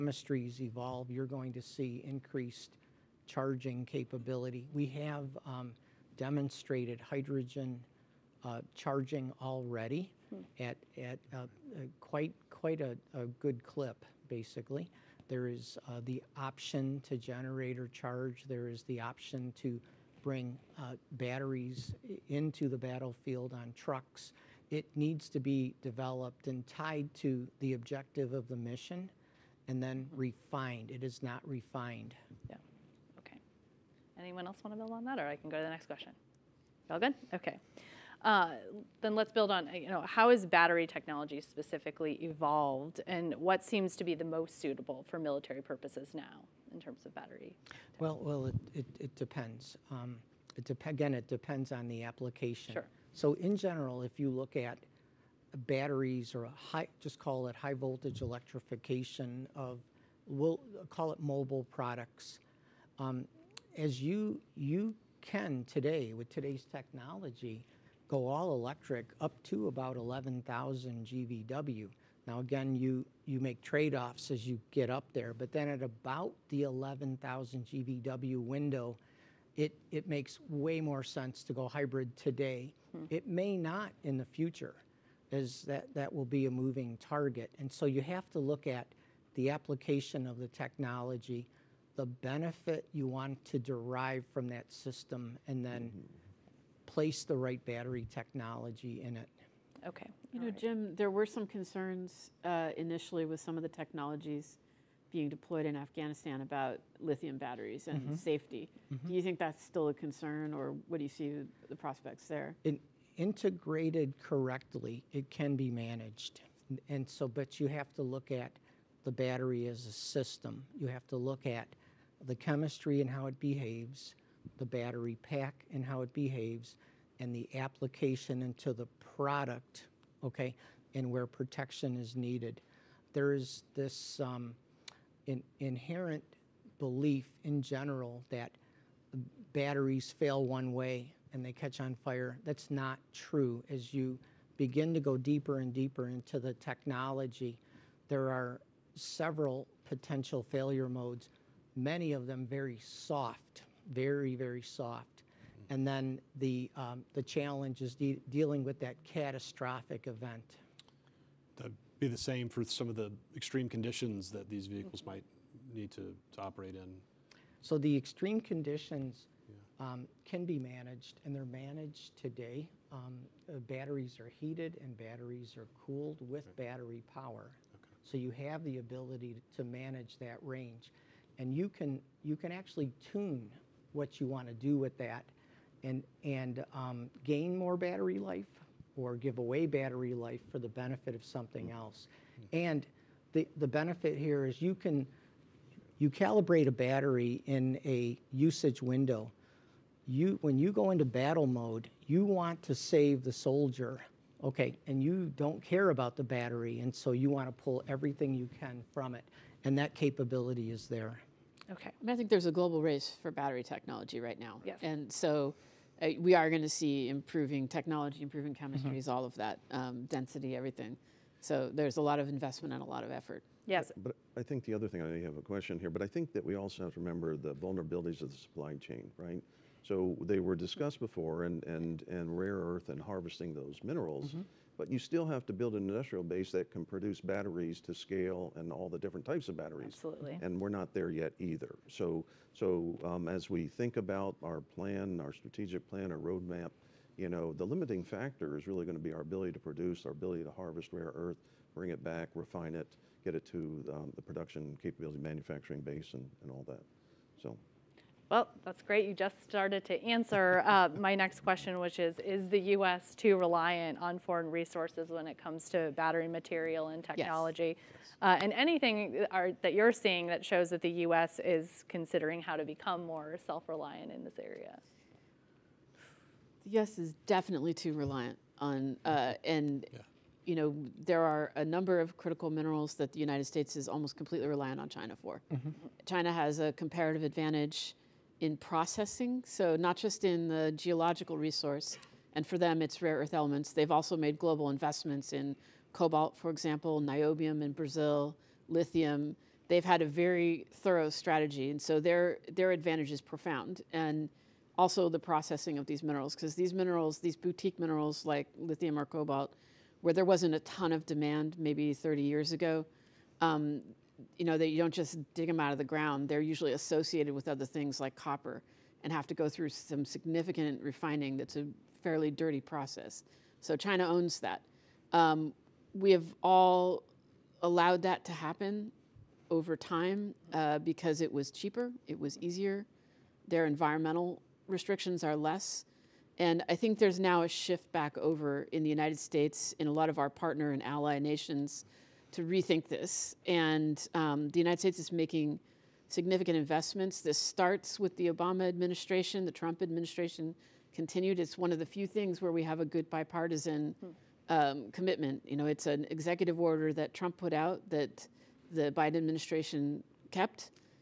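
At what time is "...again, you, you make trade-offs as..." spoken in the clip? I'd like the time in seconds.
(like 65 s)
72 s.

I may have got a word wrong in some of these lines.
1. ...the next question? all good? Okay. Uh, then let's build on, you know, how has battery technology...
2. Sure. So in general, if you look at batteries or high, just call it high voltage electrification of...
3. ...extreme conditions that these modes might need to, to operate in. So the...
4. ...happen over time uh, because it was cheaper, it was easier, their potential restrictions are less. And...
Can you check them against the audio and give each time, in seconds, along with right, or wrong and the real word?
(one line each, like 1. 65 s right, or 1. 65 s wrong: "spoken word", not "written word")
1. 35 s right
2. 52 s right
3. 163 s wrong: "vehicles", not "modes"
4. 328 s wrong: "environmental", not "potential".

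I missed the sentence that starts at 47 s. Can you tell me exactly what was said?
Well, well, it, it, it depends.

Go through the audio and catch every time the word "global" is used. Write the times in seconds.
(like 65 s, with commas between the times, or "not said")
212 s, 294 s.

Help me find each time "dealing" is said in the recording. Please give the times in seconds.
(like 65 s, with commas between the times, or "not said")
158 s.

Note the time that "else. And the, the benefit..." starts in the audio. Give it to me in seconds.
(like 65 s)
191 s.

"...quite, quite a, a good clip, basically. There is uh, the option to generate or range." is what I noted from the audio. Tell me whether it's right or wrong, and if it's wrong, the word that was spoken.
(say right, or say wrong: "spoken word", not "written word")
wrong: "charge", not "range".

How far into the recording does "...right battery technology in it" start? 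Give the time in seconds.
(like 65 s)
97 s.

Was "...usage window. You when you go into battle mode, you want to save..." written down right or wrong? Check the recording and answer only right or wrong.
right.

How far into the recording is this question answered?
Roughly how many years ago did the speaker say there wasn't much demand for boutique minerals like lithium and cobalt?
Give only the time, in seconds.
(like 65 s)
311 s.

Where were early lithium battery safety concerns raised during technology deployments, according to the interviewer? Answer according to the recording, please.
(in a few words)
Afghanistan.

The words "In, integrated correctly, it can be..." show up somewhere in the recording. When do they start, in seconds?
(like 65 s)
112 s.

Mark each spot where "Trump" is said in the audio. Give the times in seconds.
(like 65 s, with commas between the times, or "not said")
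349 s, 357 s.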